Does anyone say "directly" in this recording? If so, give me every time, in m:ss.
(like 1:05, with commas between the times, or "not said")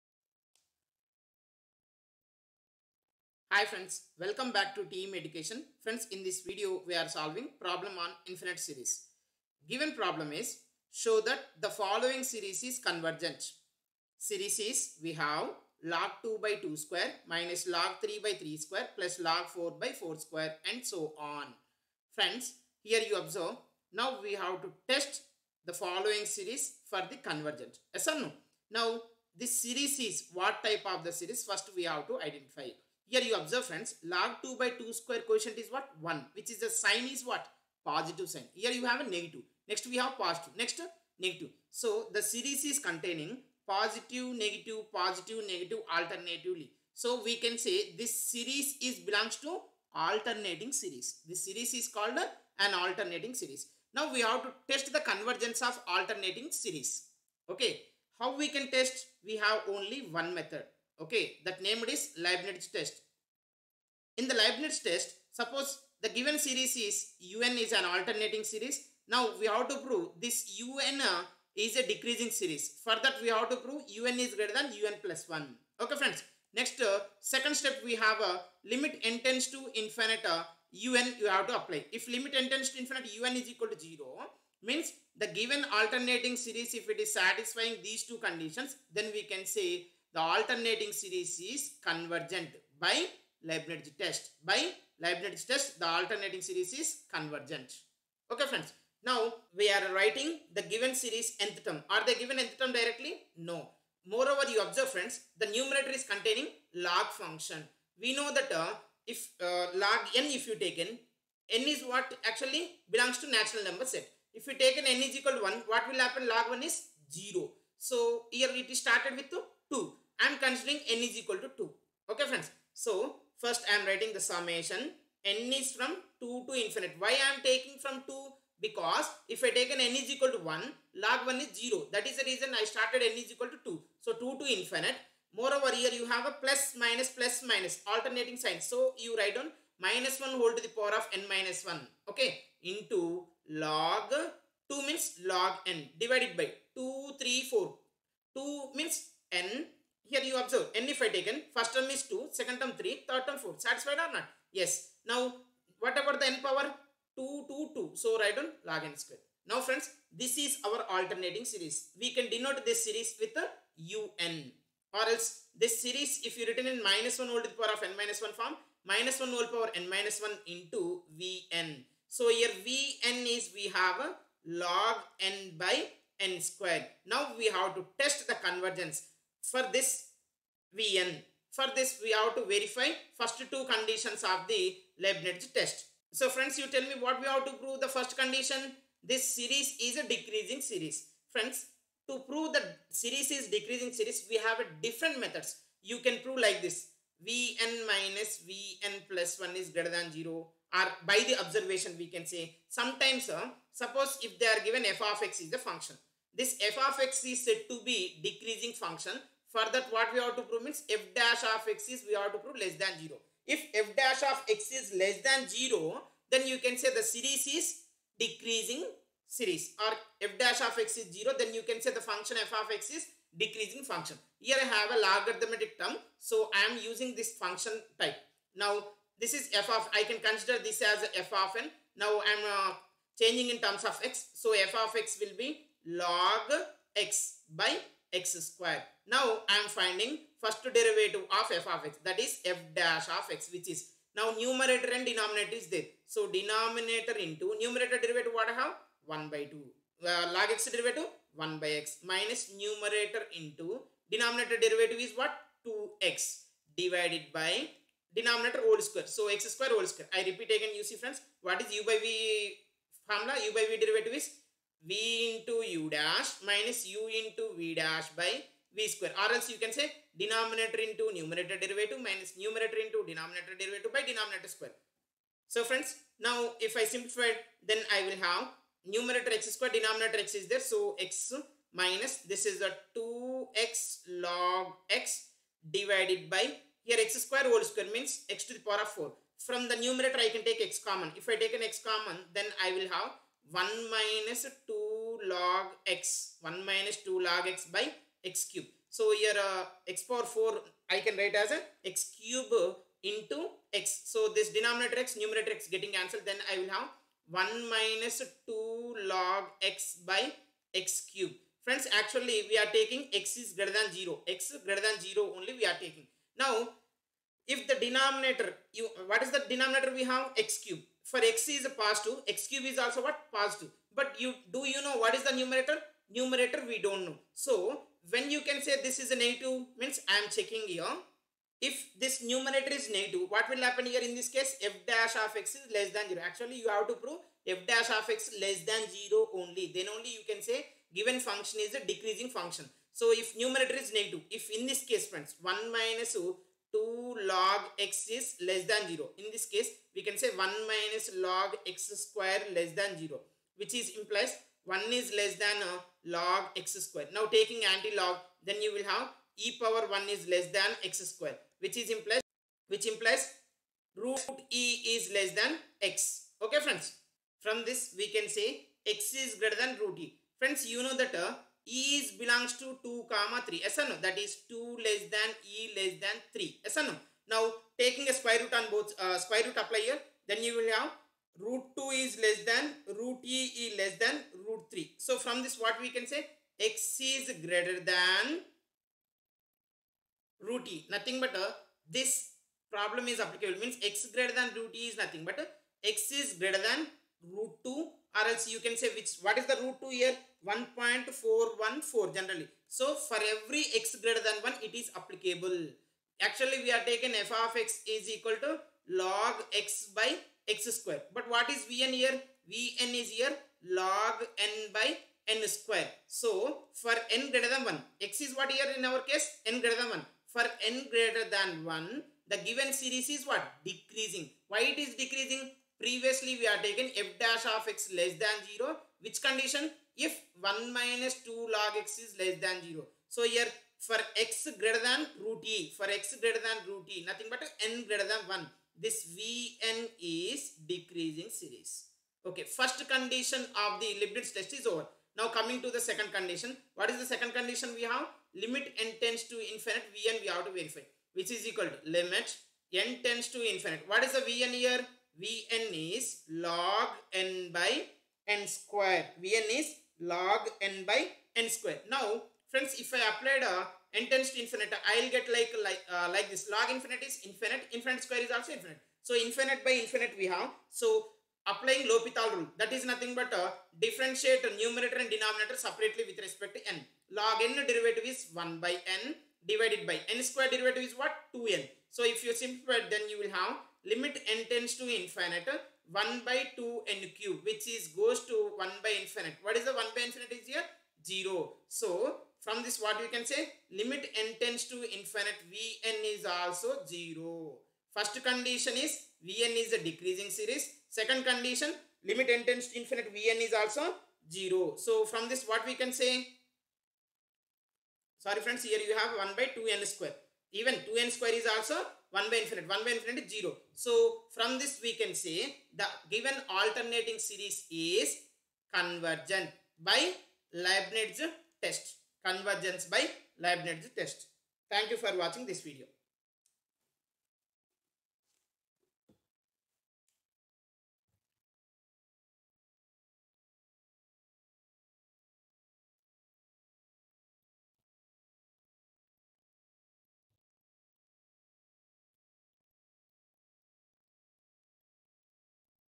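1:42.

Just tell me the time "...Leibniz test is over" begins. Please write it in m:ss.
7:24.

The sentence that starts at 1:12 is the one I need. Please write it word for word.
For that we have to prove un is greater than un plus 1.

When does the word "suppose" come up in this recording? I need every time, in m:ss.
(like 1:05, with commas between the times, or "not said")
1:05, 3:23.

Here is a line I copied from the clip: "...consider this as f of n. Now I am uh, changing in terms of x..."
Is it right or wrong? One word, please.
right.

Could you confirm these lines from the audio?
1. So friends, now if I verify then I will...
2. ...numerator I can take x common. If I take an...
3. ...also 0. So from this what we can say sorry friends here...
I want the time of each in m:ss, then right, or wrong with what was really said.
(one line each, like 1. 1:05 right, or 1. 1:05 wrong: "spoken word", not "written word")
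1. 4:35 wrong: "simplify", not "verify"
2. 4:49 right
3. 8:23 right.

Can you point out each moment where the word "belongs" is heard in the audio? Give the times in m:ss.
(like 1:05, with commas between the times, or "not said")
0:48, 1:52, 6:12.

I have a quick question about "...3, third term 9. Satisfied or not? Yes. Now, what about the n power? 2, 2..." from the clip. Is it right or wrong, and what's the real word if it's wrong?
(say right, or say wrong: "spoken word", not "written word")
wrong: "4", not "9".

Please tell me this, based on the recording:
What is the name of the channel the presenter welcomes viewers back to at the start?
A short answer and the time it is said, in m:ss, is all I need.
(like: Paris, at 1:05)
Team Education, at 0:04.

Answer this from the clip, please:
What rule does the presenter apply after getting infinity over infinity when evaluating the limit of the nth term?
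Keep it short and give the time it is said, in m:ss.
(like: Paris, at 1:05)
L'Hopital rule, at 7:51.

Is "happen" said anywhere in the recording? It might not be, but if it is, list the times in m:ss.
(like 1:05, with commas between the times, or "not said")
1:55, 5:33.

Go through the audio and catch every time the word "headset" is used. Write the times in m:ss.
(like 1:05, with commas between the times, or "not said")
not said.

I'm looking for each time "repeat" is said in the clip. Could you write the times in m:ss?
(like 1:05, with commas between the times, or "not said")
4:20.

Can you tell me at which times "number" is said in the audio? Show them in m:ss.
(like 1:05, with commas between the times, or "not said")
1:53.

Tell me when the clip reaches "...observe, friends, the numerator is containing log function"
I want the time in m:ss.
1:44.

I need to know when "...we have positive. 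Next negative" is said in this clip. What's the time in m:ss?
0:39.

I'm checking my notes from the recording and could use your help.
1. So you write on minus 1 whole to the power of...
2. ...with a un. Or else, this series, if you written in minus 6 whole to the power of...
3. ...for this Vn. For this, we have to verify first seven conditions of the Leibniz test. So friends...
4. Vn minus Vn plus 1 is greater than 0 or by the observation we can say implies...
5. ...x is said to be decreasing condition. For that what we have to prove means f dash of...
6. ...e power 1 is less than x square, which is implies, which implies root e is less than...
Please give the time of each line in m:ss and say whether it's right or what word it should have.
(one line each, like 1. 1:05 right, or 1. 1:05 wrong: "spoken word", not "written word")
1. 2:18 right
2. 2:43 wrong: "1", not "6"
3. 2:59 wrong: "two", not "seven"
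4. 3:17 wrong: "sometimes", not "implies"
5. 3:27 wrong: "function", not "condition"
6. 5:59 right.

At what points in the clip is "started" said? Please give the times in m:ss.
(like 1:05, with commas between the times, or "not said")
1:58, 2:12.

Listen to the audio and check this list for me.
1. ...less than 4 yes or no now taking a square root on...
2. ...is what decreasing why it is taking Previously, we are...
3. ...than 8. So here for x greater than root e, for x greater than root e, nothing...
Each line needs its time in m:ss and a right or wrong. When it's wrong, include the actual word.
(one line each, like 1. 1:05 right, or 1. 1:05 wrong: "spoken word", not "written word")
1. 6:15 wrong: "3", not "4"
2. 7:03 wrong: "decreasing", not "taking"
3. 7:12 wrong: "0", not "8".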